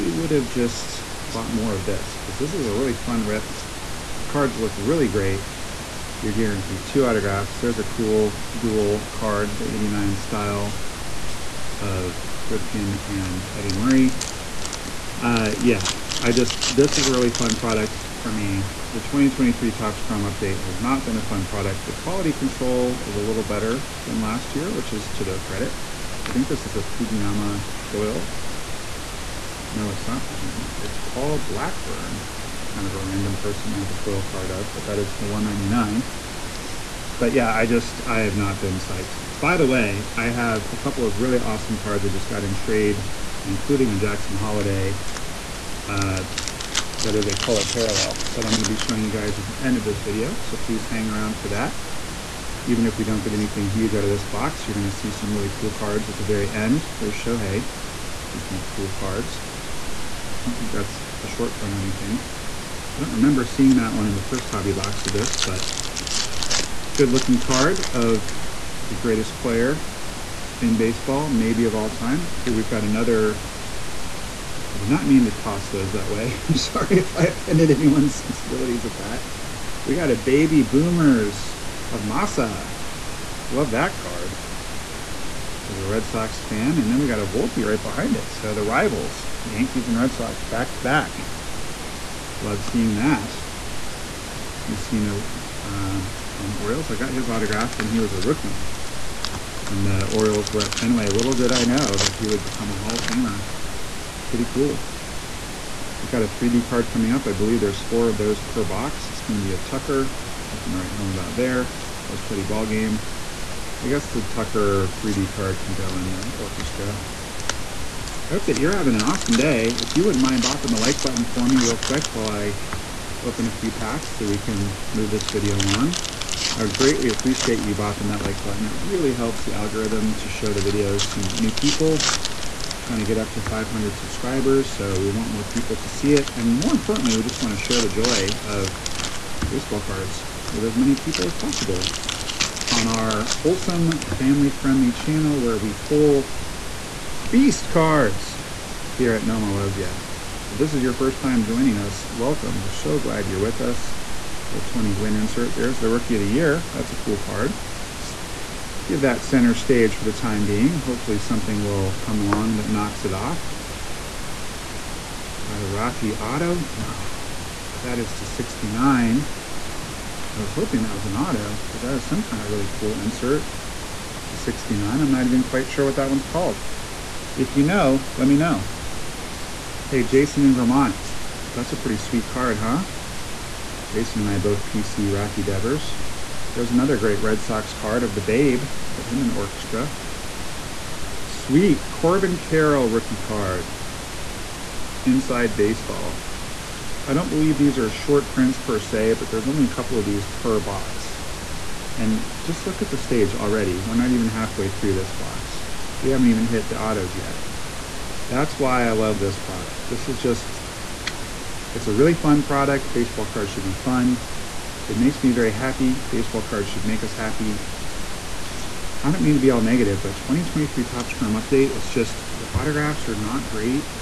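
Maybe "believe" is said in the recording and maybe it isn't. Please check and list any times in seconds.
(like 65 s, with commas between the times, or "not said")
107 s, 197 s.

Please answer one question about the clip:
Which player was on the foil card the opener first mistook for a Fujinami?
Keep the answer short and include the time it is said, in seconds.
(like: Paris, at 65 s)
Paul Blackburn, at 30 s.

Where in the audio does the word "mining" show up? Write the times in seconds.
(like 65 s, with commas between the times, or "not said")
not said.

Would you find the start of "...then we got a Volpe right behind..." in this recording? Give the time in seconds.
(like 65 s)
86 s.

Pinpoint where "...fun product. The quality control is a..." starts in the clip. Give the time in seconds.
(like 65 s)
21 s.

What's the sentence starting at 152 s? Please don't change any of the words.
We're so glad you're with us.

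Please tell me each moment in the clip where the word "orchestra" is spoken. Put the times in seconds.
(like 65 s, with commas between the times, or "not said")
116 s, 189 s.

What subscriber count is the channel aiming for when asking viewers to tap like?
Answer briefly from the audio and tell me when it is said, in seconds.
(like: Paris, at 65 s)
500, at 133 s.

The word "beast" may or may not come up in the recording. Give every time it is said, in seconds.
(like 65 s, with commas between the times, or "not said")
147 s.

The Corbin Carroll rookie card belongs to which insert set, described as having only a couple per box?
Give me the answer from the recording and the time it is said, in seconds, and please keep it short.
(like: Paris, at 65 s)
Inside Baseball, at 195 s.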